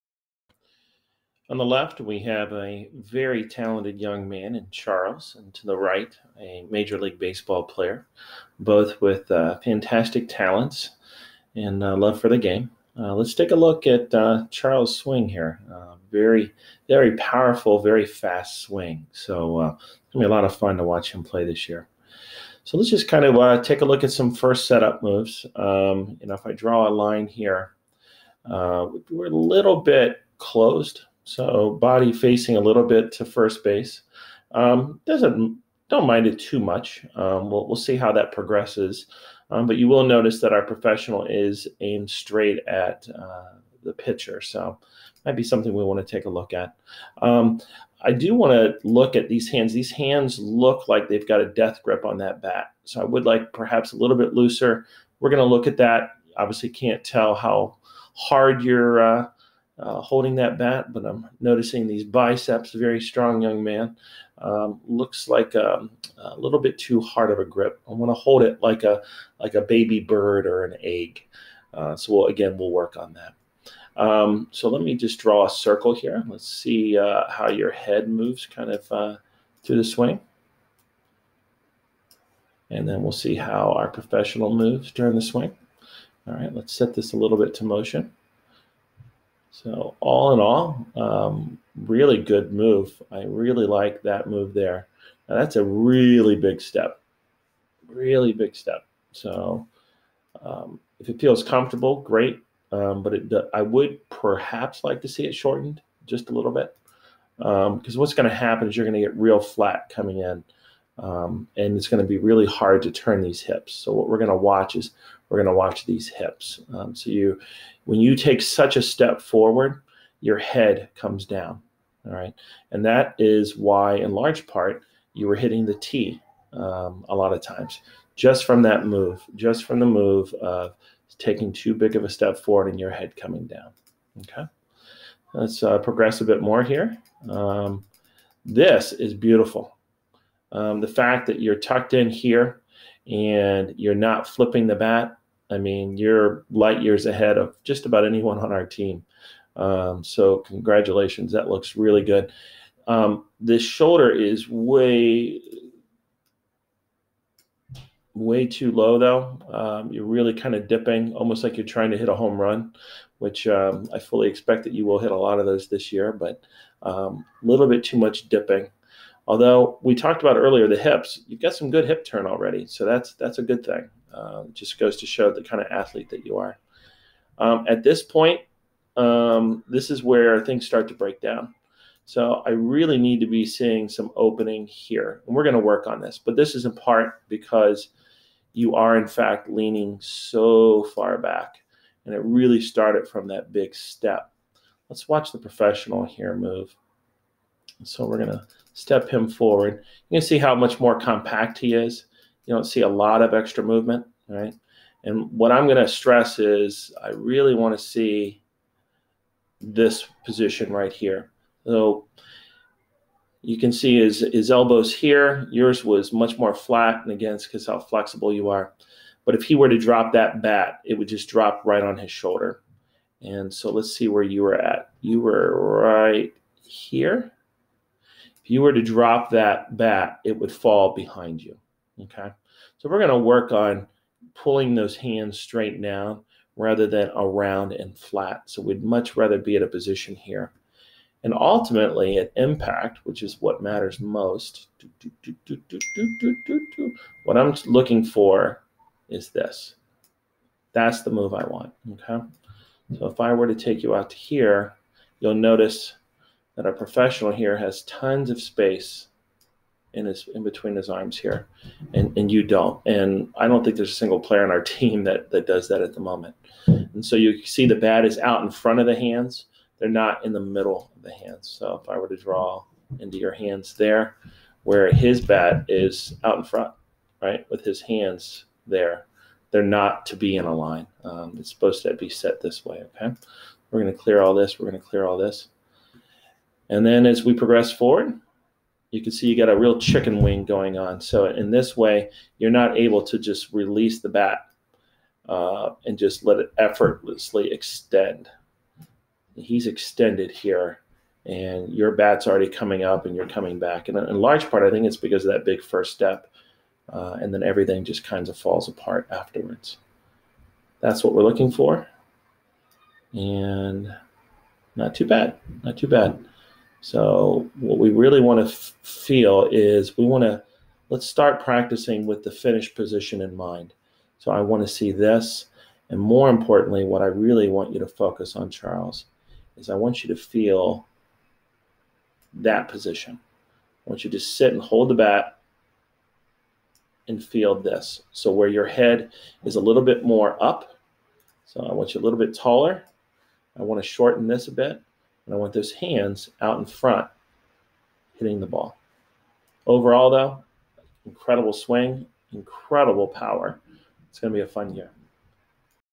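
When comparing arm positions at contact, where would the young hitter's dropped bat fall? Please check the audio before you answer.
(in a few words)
behind you.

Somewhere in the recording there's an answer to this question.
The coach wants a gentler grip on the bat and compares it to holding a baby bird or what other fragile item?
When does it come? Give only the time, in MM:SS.
01:10.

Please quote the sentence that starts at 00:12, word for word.
Uh, let's take a look at uh, Charles' swing here.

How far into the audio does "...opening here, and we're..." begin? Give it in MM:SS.
03:04.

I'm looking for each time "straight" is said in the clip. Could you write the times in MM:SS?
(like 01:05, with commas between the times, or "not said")
00:42, 03:55.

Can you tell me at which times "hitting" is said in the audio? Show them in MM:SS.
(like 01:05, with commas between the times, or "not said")
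02:05, 05:48.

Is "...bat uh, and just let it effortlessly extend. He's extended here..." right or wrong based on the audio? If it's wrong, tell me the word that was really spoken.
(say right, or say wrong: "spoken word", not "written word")
right.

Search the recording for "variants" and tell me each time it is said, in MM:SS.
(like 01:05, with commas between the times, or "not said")
not said.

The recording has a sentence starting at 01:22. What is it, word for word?
And then we'll see how our professional moves during the swing.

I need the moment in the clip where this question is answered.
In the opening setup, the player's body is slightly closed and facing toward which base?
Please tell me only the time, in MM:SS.
00:33.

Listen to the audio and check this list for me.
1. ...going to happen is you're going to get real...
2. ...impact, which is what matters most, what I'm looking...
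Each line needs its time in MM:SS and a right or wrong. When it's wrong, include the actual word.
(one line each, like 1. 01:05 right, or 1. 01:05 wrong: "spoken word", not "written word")
1. 01:48 right
2. 04:02 right.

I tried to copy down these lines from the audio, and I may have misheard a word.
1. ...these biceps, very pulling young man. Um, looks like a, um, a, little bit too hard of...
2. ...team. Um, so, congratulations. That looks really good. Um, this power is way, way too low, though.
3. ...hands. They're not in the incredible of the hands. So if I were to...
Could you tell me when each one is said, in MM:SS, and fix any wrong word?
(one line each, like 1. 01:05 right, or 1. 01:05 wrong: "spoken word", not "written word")
1. 01:01 wrong: "strong", not "pulling"
2. 02:28 wrong: "shoulder", not "power"
3. 04:28 wrong: "middle", not "incredible".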